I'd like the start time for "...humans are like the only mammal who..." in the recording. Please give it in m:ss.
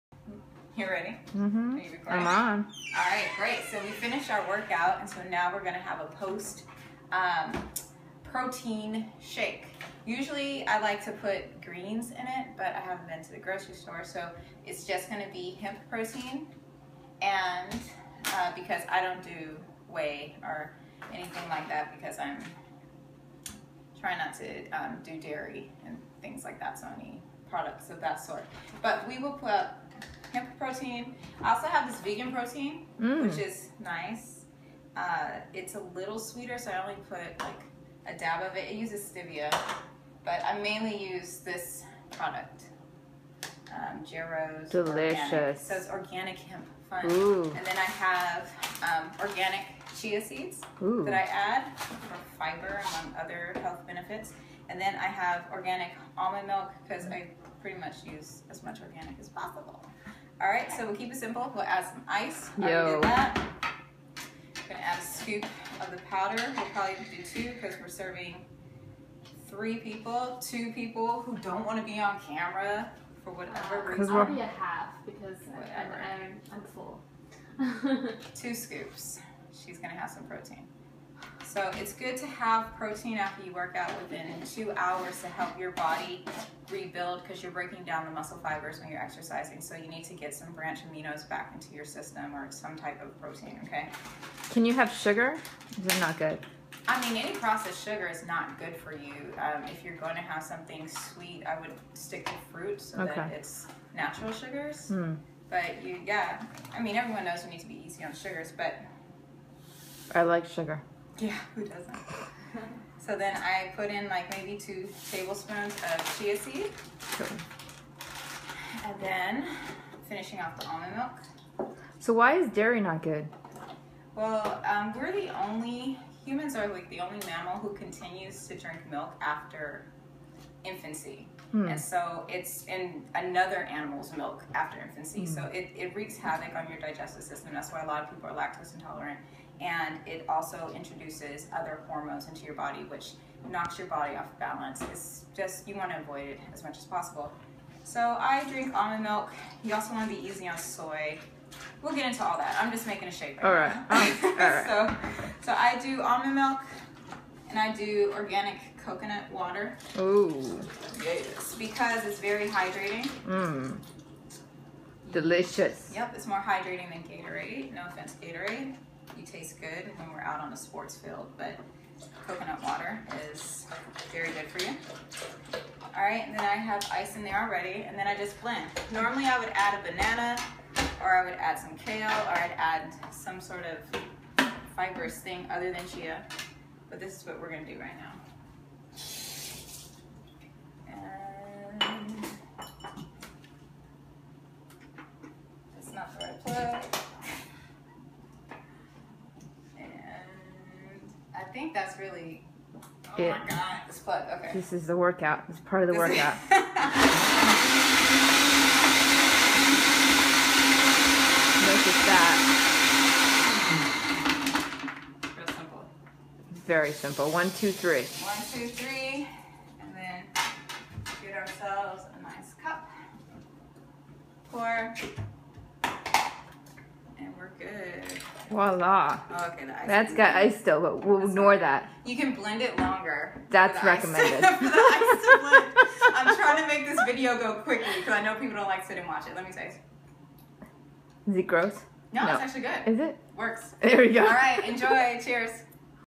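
2:06.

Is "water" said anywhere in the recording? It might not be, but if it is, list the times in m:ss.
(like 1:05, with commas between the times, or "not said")
2:39, 2:52.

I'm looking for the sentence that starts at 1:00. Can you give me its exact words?
All right, so we'll keep it simple.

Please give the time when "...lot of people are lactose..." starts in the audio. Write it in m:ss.
2:17.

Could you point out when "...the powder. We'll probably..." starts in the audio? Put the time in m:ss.
1:05.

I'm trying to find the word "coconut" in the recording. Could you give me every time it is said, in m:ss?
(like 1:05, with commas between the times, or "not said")
2:38, 2:52.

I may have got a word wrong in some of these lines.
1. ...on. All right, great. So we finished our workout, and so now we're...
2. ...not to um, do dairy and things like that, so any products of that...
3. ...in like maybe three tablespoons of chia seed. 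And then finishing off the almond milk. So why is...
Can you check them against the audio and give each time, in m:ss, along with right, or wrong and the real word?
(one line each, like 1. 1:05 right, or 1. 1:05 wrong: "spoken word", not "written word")
1. 0:02 right
2. 0:24 right
3. 1:53 wrong: "two", not "three".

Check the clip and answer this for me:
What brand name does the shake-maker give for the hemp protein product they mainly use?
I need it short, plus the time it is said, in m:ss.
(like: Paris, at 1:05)
Jero's Delicious, at 0:44.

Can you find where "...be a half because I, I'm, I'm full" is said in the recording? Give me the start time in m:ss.
1:14.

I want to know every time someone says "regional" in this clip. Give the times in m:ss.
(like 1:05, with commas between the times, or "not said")
not said.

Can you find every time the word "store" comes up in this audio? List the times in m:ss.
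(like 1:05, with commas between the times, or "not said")
0:13.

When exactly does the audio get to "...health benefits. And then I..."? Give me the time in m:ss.
0:53.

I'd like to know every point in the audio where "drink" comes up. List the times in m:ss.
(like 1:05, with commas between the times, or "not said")
2:08, 2:28.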